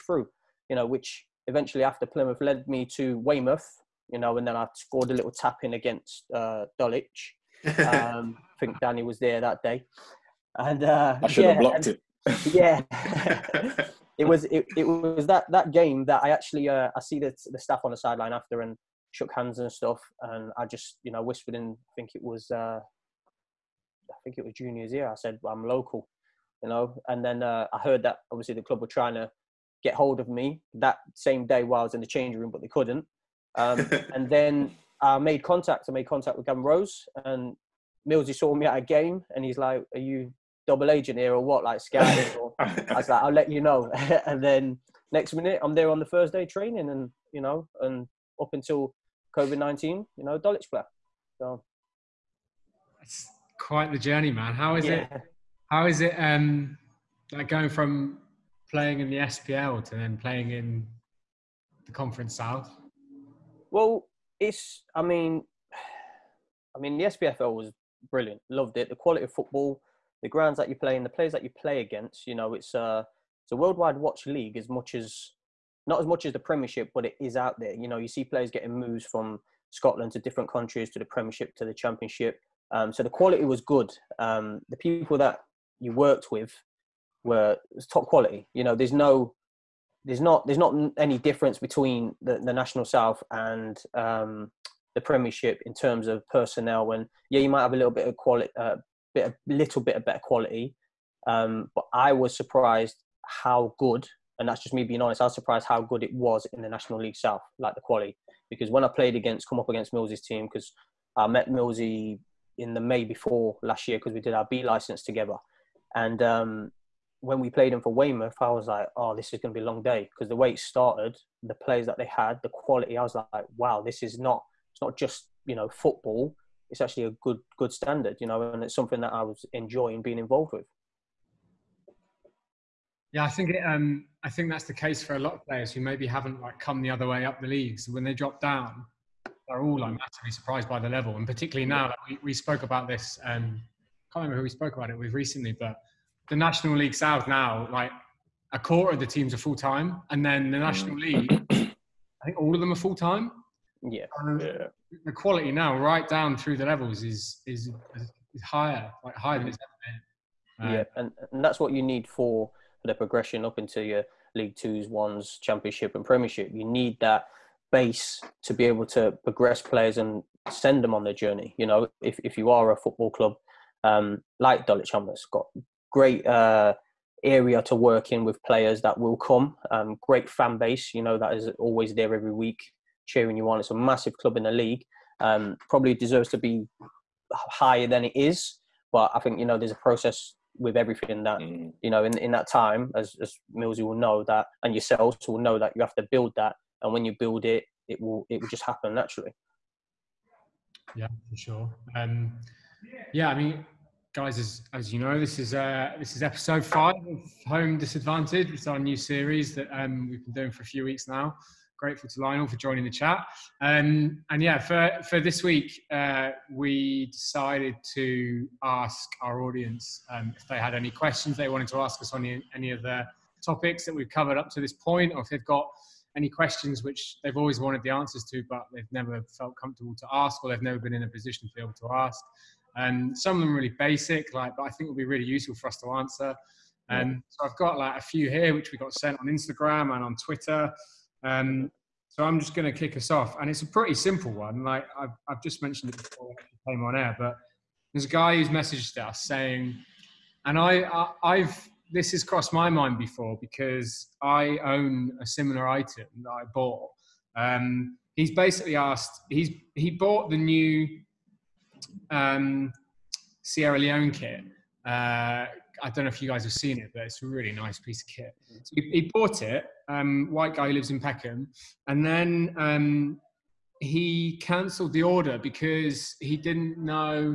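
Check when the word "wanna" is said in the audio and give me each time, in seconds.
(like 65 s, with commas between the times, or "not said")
not said.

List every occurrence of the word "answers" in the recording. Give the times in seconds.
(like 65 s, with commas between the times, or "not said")
227 s, 235 s.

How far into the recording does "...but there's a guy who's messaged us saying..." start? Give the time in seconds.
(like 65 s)
247 s.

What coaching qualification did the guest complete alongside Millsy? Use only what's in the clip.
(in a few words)
B license.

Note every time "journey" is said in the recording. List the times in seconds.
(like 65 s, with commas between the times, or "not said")
53 s, 171 s.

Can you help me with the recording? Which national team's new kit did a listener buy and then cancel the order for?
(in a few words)
Sierra Leone.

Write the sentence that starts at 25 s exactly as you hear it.
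I said I'm local, you know.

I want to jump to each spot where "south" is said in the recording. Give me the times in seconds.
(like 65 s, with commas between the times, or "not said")
62 s, 92 s, 107 s, 146 s.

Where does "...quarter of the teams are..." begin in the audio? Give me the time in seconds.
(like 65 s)
148 s.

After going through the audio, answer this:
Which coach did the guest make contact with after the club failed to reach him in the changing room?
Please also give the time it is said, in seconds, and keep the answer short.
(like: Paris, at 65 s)
Gavin Rose, at 36 s.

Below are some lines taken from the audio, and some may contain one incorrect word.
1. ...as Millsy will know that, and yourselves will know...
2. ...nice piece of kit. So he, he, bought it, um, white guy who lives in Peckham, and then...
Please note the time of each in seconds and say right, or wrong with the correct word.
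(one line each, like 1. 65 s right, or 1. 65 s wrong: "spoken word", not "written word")
1. 193 s right
2. 267 s right.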